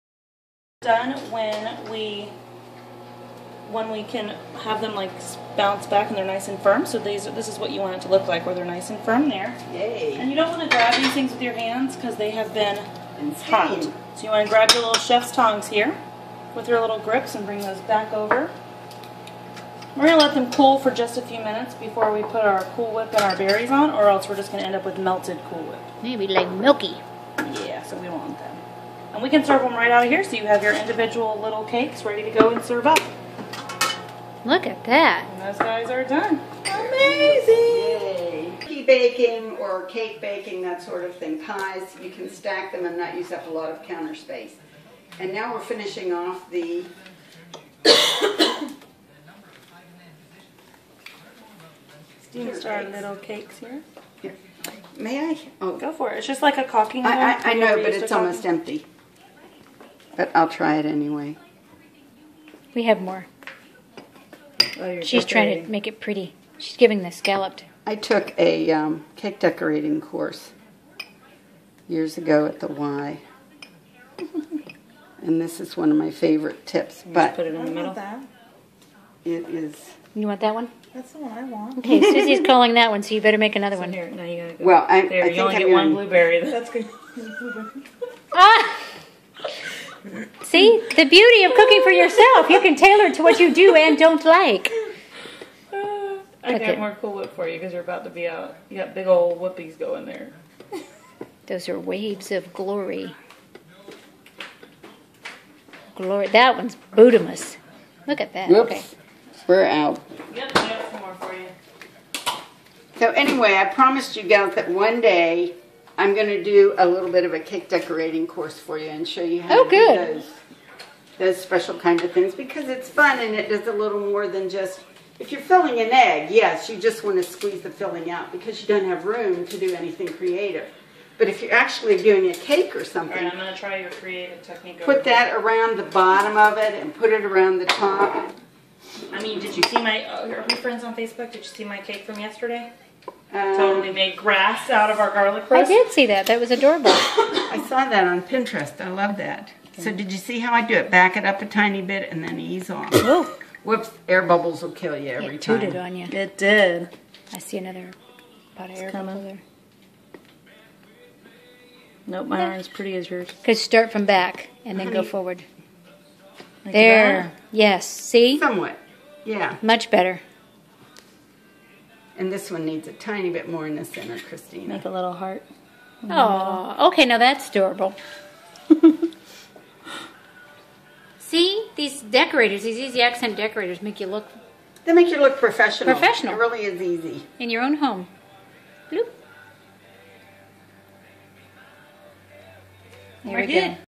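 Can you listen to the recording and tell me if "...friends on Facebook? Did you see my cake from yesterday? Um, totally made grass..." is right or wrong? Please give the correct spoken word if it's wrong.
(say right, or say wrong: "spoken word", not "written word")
right.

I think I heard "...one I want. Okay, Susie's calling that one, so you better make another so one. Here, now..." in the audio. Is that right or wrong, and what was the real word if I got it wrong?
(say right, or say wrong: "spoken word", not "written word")
right.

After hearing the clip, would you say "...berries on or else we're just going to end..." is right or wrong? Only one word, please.
right.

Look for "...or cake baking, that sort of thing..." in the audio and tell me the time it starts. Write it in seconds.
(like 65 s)
39 s.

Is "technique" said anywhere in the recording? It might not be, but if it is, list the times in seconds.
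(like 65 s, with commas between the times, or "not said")
134 s.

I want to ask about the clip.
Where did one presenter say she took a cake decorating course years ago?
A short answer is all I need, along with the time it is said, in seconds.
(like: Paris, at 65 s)
the Y, at 72 s.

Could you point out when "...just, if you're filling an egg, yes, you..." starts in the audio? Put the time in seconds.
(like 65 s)
124 s.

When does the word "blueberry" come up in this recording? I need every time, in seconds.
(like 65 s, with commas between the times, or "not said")
85 s.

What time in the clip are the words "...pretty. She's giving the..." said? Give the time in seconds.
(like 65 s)
65 s.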